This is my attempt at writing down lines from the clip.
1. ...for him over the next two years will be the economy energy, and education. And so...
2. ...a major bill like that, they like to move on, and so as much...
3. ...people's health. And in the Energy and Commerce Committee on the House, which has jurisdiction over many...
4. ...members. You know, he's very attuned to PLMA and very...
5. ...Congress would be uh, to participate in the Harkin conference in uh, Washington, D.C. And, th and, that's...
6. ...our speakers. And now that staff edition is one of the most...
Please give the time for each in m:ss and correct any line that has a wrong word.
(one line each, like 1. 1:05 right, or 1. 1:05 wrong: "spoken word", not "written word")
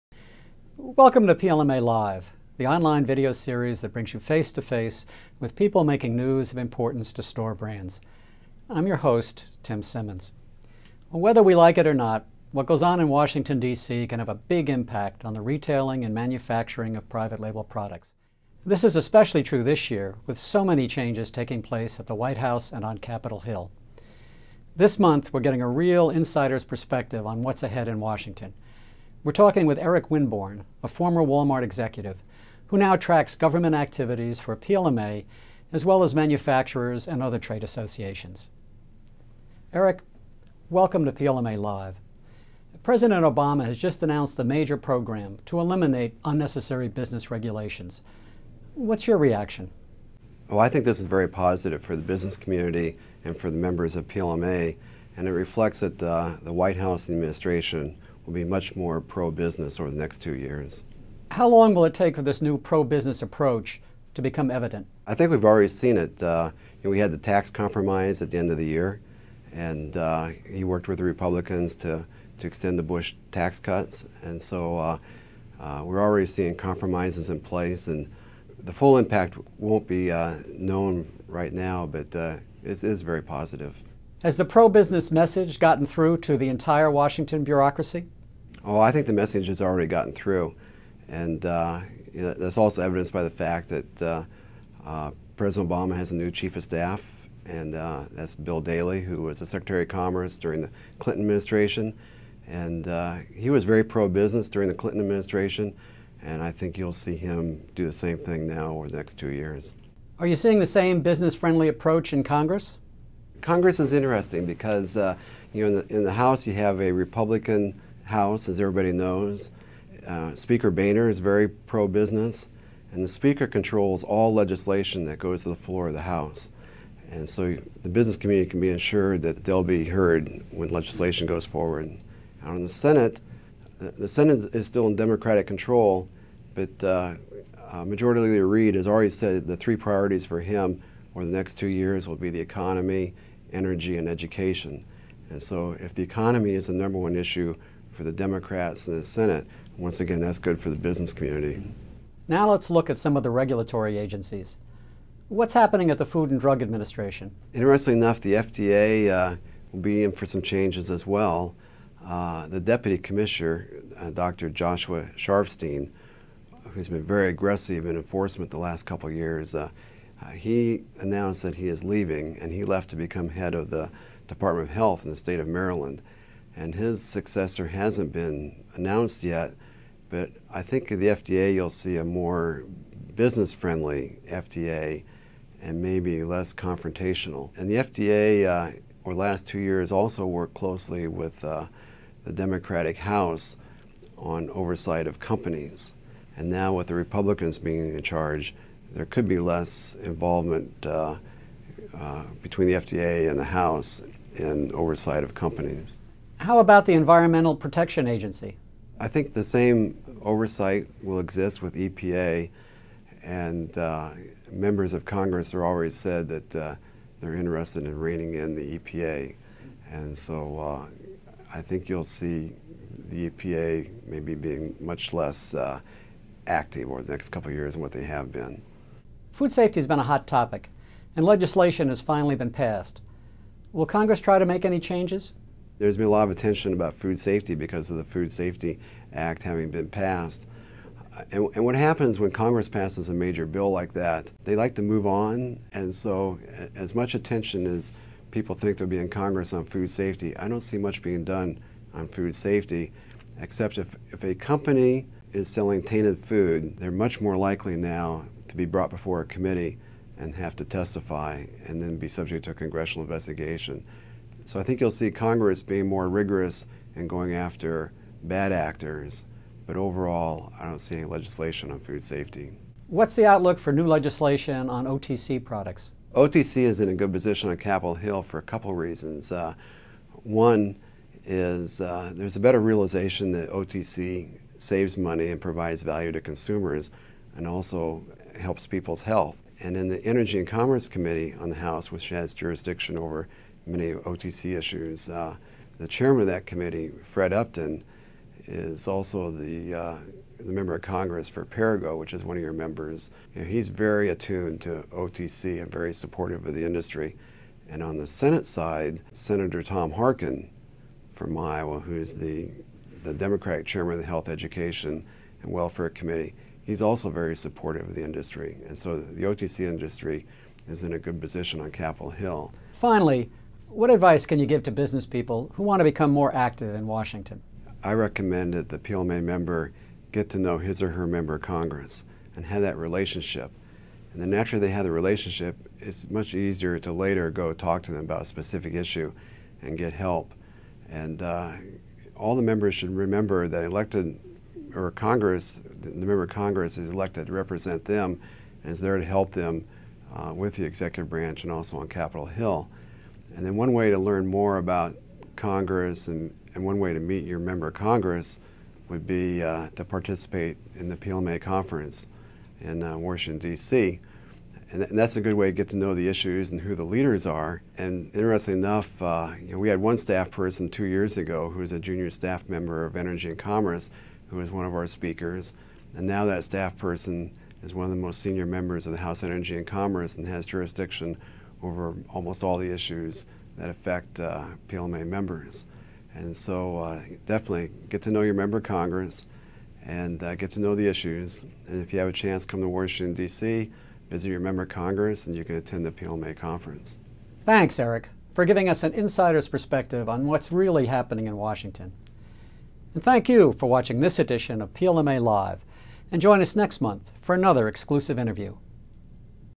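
1. 2:20 right
2. 4:03 right
3. 4:48 right
4. 5:02 wrong: "OTC", not "PLMA"
5. 5:57 wrong: "PLMA", not "Harkin"
6. 6:14 wrong: "person", not "edition".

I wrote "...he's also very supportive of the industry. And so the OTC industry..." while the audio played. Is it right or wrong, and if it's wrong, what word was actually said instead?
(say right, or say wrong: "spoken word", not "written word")
right.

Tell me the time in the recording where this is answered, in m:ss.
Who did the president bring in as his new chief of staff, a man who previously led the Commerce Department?
1:38.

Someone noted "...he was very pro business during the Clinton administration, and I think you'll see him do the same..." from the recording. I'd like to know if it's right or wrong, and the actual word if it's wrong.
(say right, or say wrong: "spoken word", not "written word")
right.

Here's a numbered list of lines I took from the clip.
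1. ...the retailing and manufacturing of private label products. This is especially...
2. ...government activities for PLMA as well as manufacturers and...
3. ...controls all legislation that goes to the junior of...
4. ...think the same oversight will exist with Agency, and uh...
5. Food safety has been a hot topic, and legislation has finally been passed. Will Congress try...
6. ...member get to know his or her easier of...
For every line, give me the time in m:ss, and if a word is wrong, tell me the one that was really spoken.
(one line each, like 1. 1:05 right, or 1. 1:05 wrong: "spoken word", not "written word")
1. 0:15 right
2. 0:33 right
3. 2:03 wrong: "floor", not "junior"
4. 3:29 wrong: "EPA", not "Agency"
5. 3:49 right
6. 5:29 wrong: "member", not "easier".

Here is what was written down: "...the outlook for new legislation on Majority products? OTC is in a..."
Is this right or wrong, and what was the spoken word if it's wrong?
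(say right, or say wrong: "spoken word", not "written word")
wrong: "OTC", not "Majority".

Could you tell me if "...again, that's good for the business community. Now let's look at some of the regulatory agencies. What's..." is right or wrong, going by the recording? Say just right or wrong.
right.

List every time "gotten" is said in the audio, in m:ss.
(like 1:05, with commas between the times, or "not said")
1:25, 1:29.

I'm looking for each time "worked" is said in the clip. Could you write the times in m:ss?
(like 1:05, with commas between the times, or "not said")
1:10, 3:10.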